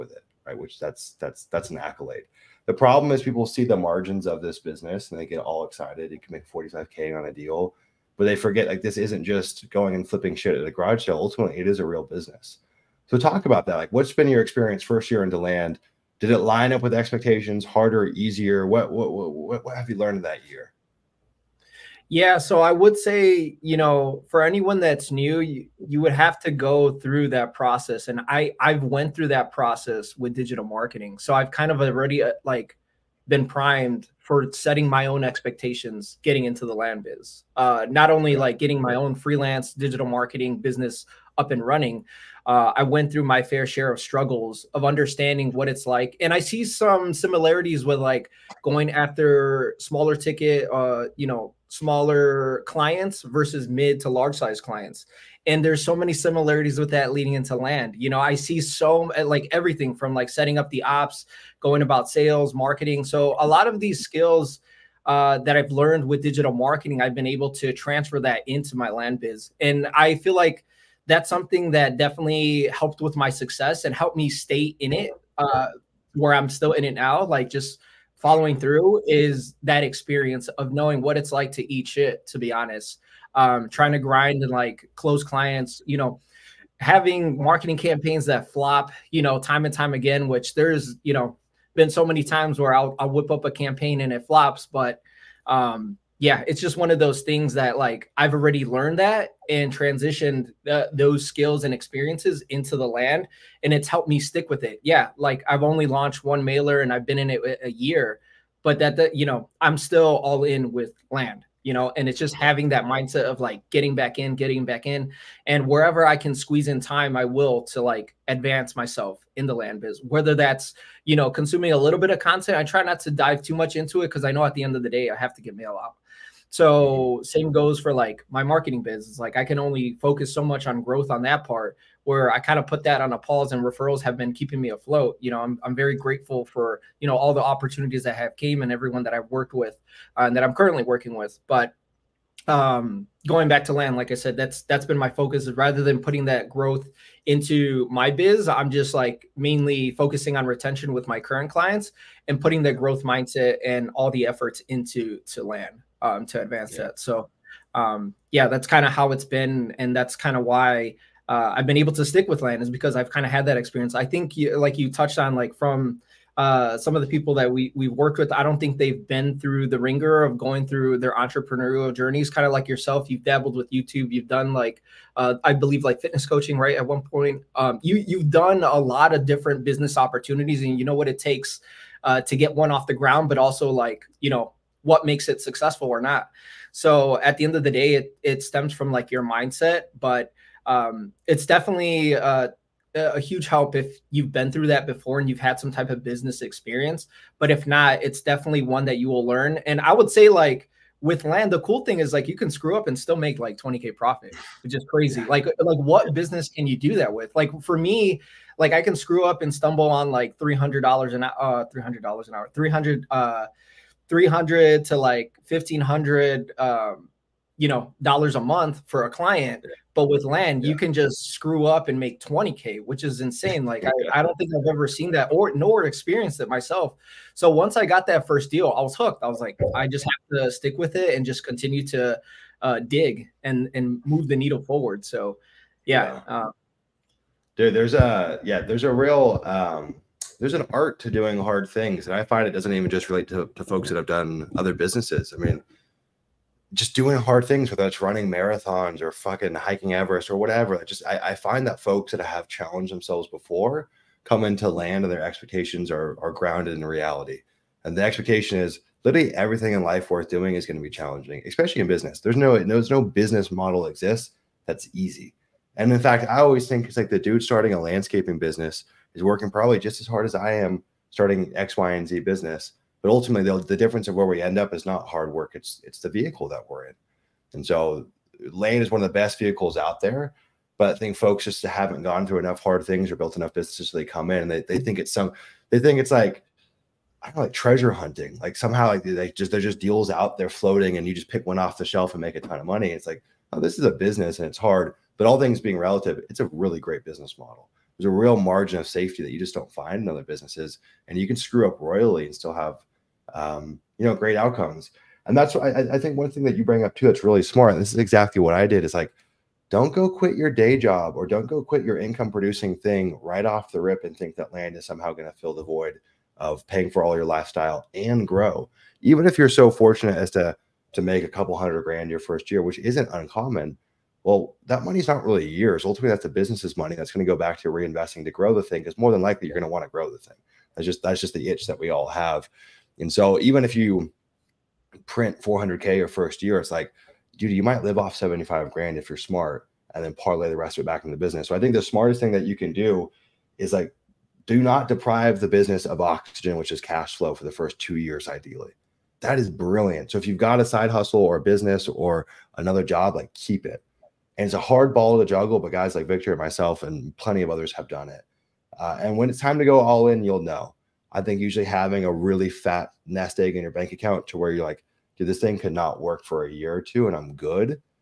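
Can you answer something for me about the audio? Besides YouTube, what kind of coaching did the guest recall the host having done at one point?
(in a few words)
Fitness coaching.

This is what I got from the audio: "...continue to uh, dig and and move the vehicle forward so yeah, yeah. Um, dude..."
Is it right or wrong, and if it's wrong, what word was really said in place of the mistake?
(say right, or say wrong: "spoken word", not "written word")
wrong: "needle", not "vehicle".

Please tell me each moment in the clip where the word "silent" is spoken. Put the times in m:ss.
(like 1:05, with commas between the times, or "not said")
not said.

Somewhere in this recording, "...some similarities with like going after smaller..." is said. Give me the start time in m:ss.
0:46.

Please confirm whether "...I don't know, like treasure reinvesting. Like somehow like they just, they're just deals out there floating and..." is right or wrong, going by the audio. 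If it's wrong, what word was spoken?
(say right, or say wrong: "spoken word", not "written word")
wrong: "hunting", not "reinvesting".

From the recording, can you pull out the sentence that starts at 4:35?
It's it's the vehicle that we're in.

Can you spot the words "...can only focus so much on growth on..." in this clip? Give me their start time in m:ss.
2:09.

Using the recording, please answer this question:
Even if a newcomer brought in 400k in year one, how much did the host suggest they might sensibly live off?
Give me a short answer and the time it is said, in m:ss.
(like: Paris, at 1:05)
75 grand, at 5:38.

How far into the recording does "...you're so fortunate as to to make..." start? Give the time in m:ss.
5:19.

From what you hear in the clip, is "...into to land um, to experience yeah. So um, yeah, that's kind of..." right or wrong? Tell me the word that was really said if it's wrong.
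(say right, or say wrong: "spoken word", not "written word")
wrong: "advance", not "experience".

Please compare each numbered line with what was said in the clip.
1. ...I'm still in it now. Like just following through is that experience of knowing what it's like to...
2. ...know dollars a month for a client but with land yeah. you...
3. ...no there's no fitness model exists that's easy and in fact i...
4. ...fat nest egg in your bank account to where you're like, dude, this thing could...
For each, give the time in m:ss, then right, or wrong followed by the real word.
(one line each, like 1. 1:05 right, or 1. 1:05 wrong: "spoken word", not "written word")
1. 1:16 right
2. 3:37 right
3. 4:22 wrong: "business", not "fitness"
4. 6:02 right.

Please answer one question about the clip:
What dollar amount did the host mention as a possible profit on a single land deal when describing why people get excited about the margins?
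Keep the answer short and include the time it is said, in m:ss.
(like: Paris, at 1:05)
45k, at 0:06.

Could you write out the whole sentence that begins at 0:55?
And there's so many similarities with that leading into land.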